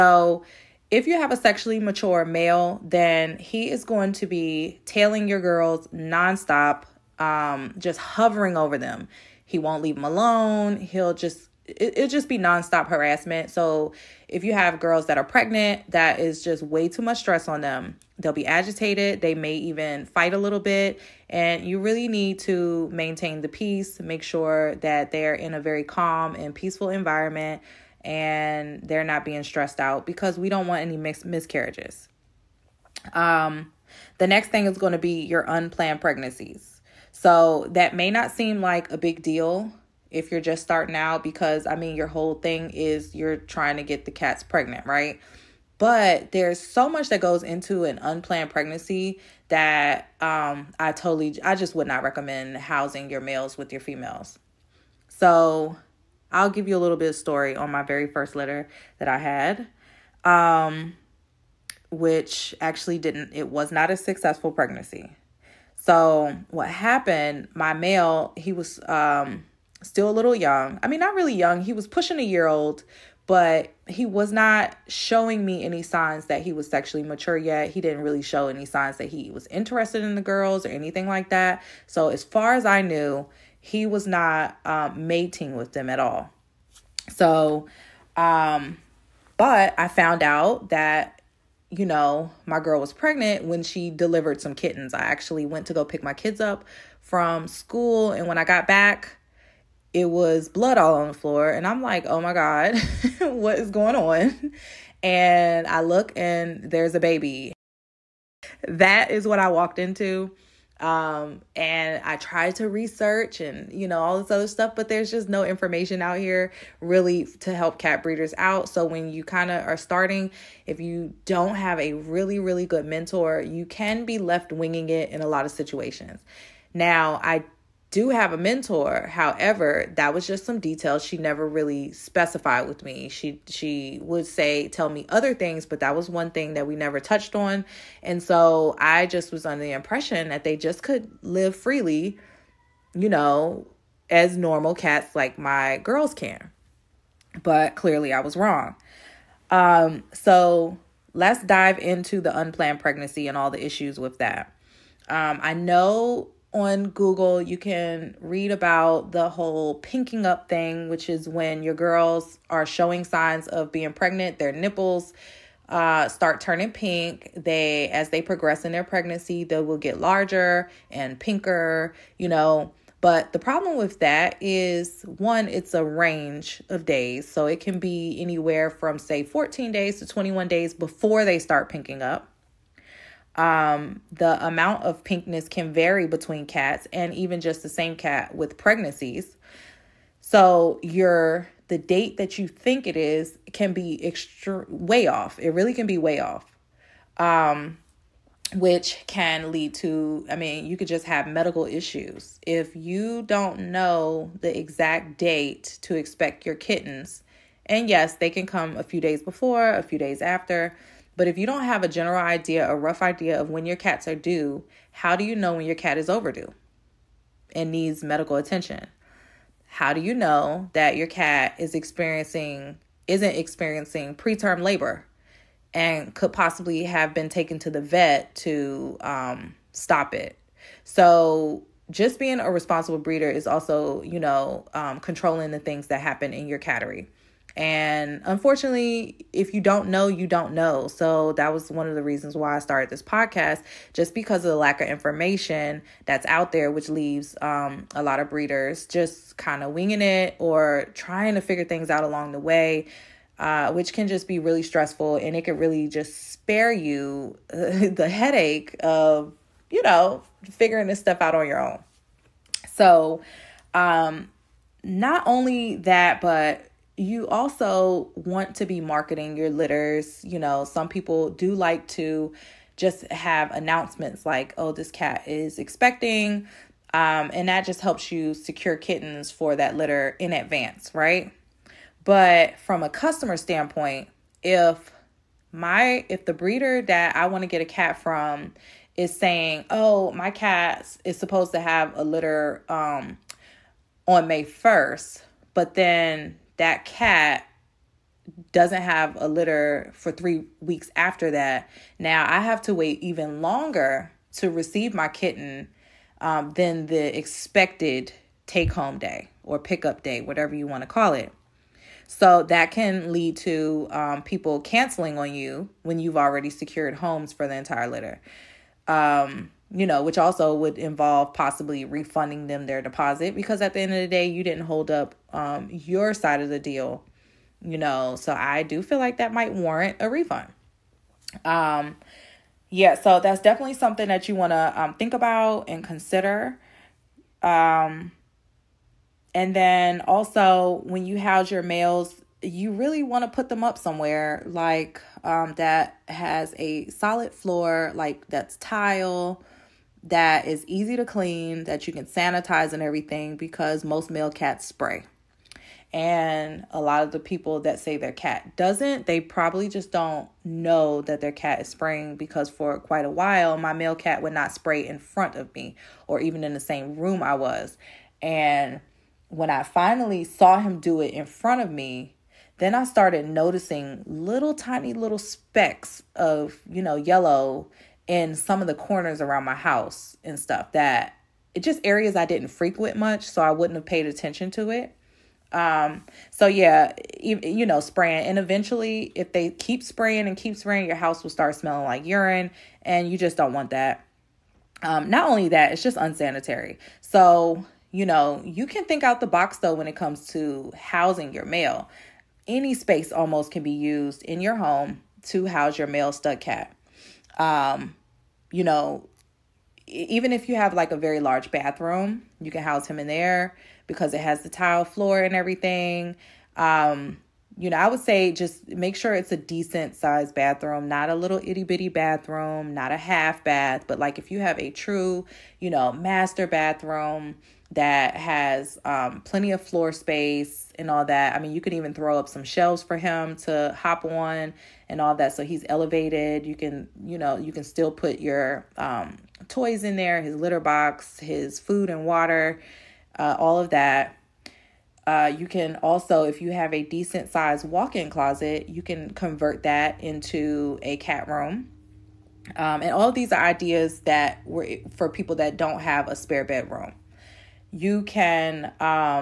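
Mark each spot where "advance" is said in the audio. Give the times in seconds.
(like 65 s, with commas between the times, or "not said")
280 s.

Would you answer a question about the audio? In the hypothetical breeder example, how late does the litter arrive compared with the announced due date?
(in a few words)
three weeks.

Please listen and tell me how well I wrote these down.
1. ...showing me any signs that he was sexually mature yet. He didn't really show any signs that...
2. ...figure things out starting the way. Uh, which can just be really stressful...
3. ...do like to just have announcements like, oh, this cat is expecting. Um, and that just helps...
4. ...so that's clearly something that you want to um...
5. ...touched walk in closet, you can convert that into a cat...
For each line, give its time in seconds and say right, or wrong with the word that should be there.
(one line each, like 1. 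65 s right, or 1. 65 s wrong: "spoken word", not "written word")
1. 74 s right
2. 251 s wrong: "along", not "starting"
3. 271 s right
4. 332 s wrong: "definitely", not "clearly"
5. 447 s wrong: "sized", not "touched".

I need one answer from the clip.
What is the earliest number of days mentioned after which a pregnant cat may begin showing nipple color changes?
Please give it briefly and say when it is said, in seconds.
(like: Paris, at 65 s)
14, at 179 s.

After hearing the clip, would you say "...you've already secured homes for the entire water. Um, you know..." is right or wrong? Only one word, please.
wrong.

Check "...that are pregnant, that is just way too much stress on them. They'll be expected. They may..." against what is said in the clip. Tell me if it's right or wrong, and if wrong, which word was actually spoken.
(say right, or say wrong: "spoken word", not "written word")
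wrong: "agitated", not "expected".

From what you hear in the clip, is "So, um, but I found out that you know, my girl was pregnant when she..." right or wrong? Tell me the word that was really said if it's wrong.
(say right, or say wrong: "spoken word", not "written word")
right.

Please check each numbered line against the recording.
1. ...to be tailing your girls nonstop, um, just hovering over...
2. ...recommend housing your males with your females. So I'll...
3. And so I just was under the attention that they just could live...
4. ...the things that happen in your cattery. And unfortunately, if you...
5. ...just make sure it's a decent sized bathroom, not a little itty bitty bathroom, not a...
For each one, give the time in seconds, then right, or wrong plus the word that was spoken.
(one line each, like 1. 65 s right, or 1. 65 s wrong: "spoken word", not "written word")
1. 4 s right
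2. 52 s right
3. 138 s wrong: "impression", not "attention"
4. 235 s right
5. 418 s right.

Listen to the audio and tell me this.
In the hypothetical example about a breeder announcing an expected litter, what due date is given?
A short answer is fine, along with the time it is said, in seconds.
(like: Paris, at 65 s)
May 1st, at 294 s.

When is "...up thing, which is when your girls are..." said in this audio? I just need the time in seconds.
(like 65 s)
160 s.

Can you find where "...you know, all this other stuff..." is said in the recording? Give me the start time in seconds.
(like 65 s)
113 s.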